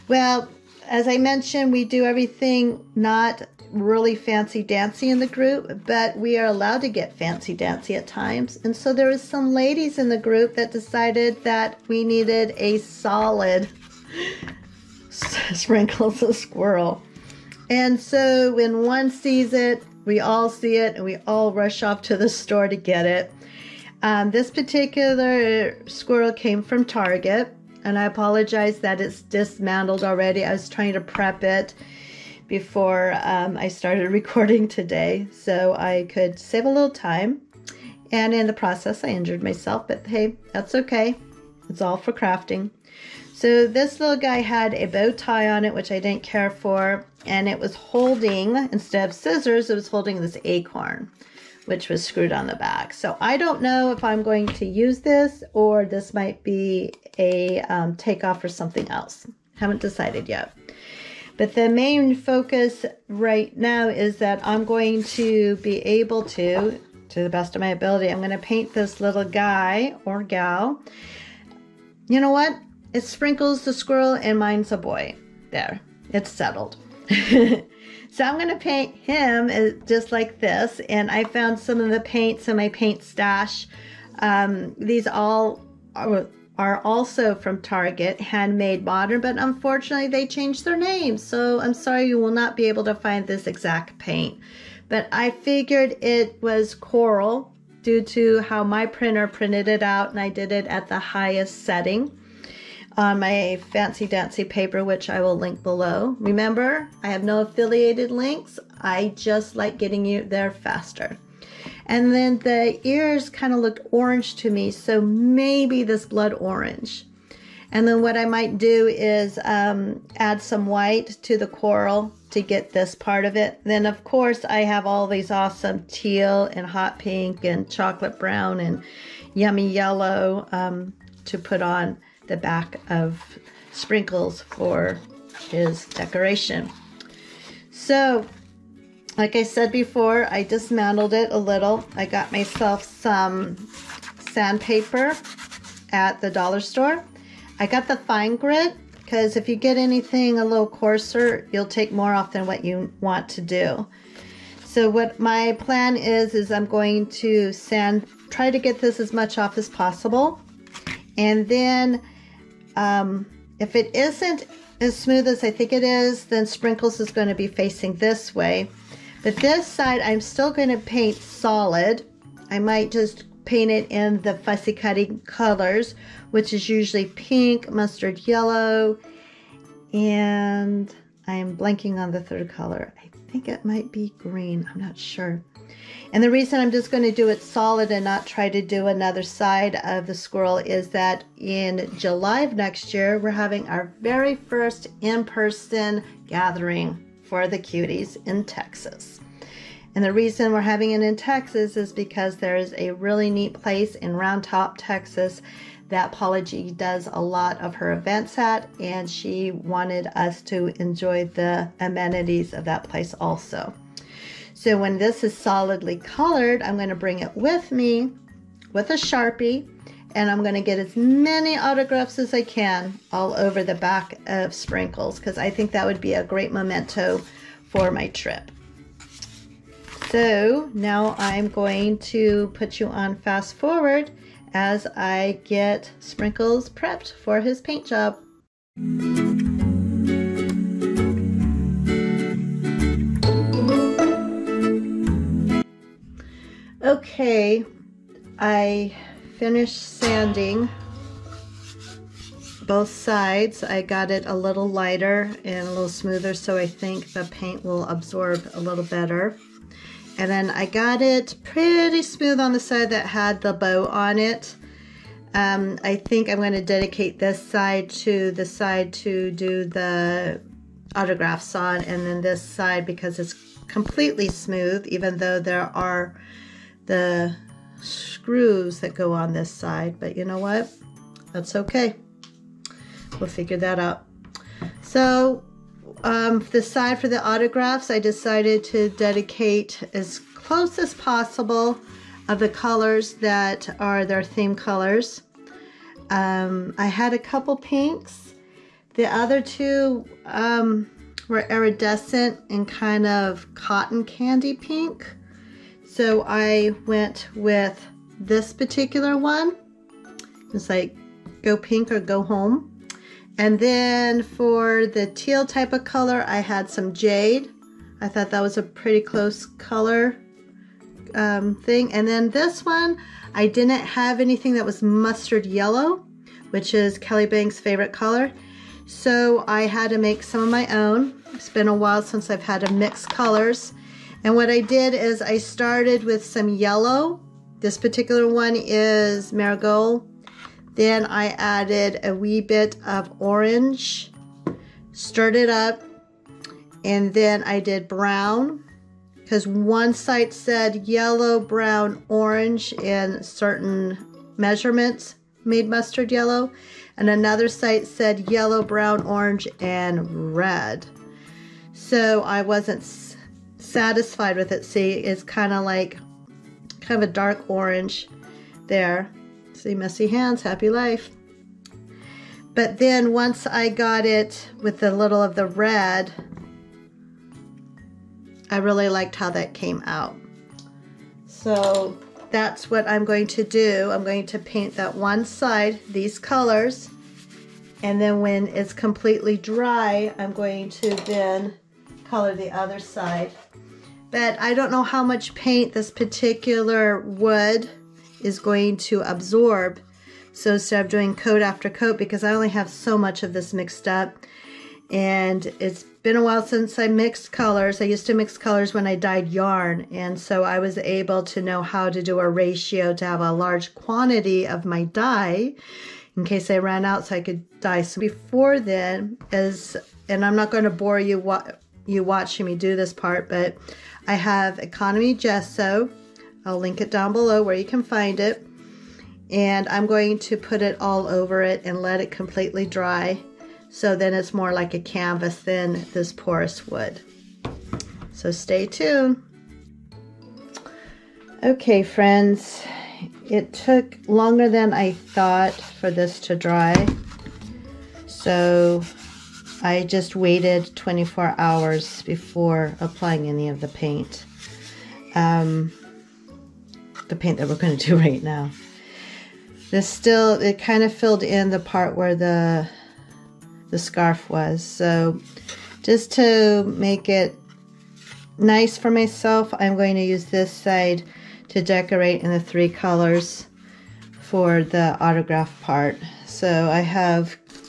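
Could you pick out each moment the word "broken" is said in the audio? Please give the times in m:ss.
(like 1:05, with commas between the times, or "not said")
not said.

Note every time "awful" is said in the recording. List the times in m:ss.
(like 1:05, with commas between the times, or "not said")
not said.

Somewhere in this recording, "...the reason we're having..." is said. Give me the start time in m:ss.
3:20.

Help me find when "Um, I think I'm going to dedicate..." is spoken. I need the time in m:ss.
4:25.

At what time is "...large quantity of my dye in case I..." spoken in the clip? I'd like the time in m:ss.
6:53.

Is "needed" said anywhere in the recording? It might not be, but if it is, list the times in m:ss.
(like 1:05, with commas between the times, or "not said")
0:12.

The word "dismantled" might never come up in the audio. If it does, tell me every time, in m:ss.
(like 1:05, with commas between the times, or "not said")
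0:29, 2:20.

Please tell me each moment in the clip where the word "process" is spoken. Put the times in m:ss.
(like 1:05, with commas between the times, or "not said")
0:38.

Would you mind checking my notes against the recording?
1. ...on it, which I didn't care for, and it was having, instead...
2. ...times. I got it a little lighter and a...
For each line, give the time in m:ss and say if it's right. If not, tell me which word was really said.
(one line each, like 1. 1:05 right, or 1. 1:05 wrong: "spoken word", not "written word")
1. 0:45 wrong: "holding", not "having"
2. 4:12 wrong: "sides", not "times".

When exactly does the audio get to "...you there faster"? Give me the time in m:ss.
1:50.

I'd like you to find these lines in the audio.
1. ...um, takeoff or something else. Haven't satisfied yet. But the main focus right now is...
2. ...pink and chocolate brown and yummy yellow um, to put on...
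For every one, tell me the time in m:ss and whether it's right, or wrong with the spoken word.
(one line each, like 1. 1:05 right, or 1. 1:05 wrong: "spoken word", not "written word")
1. 0:57 wrong: "decided", not "satisfied"
2. 2:06 right.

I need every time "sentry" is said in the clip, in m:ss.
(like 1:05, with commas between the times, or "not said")
not said.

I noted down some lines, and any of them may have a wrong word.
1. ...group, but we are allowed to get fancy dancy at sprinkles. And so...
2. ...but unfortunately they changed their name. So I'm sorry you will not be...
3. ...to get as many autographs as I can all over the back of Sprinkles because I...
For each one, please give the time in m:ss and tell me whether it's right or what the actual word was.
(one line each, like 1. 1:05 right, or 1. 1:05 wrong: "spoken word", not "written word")
1. 0:05 wrong: "times", not "sprinkles"
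2. 1:29 right
3. 3:40 right.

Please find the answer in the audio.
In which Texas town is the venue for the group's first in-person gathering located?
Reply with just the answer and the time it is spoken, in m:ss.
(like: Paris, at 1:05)
Round Top, at 3:24.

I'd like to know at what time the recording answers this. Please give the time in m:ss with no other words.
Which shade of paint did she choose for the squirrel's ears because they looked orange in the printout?
1:54.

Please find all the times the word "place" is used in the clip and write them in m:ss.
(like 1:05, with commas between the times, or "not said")
3:23, 3:32.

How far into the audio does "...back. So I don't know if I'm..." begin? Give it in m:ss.
0:52.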